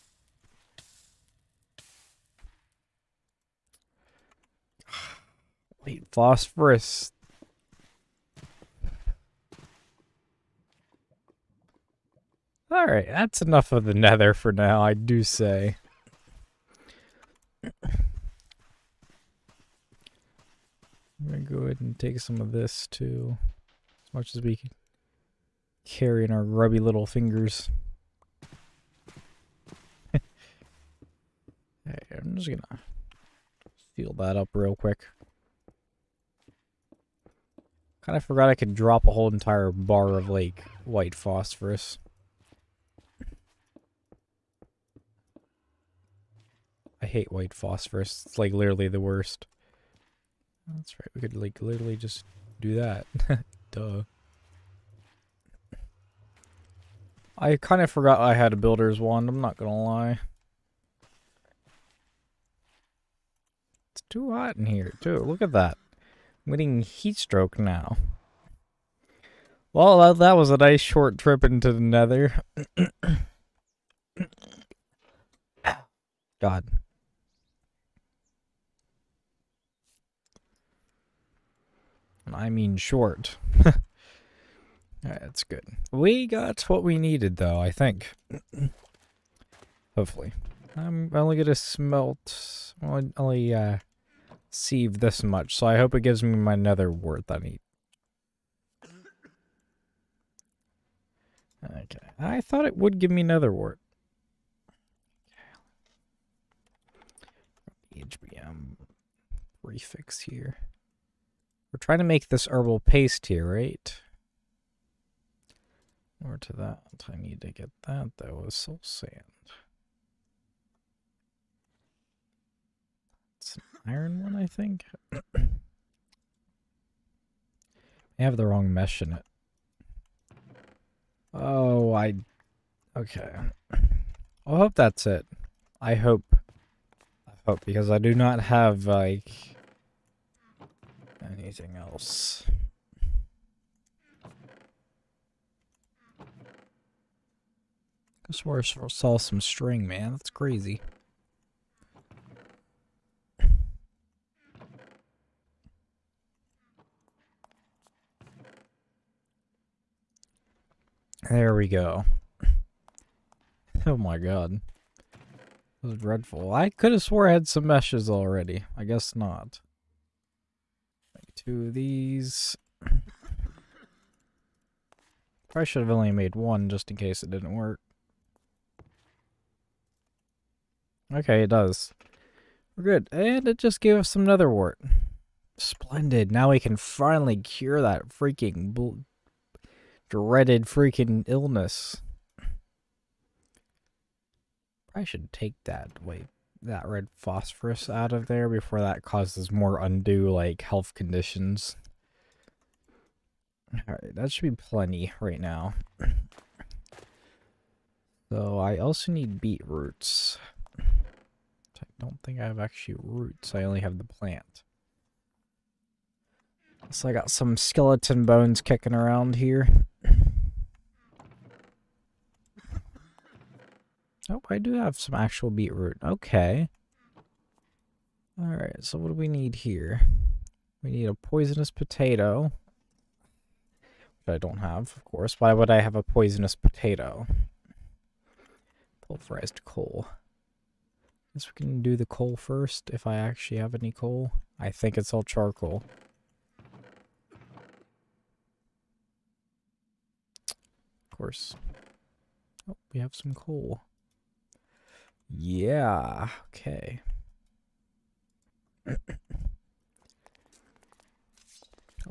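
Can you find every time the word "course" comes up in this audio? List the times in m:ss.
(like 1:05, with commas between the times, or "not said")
3:55, 4:11.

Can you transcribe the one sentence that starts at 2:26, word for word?
I swear I saw some string, man.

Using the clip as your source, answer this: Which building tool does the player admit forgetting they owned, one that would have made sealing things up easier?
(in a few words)
builder's wand.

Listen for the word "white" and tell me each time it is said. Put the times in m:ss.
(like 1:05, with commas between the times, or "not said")
0:40, 0:47.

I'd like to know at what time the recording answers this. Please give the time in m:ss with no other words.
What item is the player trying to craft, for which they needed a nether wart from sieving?
1:52.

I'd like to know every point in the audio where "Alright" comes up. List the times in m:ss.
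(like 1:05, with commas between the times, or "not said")
0:12, 3:23, 3:48.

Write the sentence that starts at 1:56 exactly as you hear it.
Or to that, I need to get that though, was soul sand.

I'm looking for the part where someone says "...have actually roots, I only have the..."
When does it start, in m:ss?
3:32.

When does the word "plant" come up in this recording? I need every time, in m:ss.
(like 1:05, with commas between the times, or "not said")
3:34.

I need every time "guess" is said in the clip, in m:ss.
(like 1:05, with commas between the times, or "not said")
2:48, 4:01.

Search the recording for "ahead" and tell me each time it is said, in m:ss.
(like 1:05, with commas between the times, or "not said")
0:21.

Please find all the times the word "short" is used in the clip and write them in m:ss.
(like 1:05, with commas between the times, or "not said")
1:10, 1:22.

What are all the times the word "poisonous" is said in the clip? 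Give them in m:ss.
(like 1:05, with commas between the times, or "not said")
3:51, 3:56.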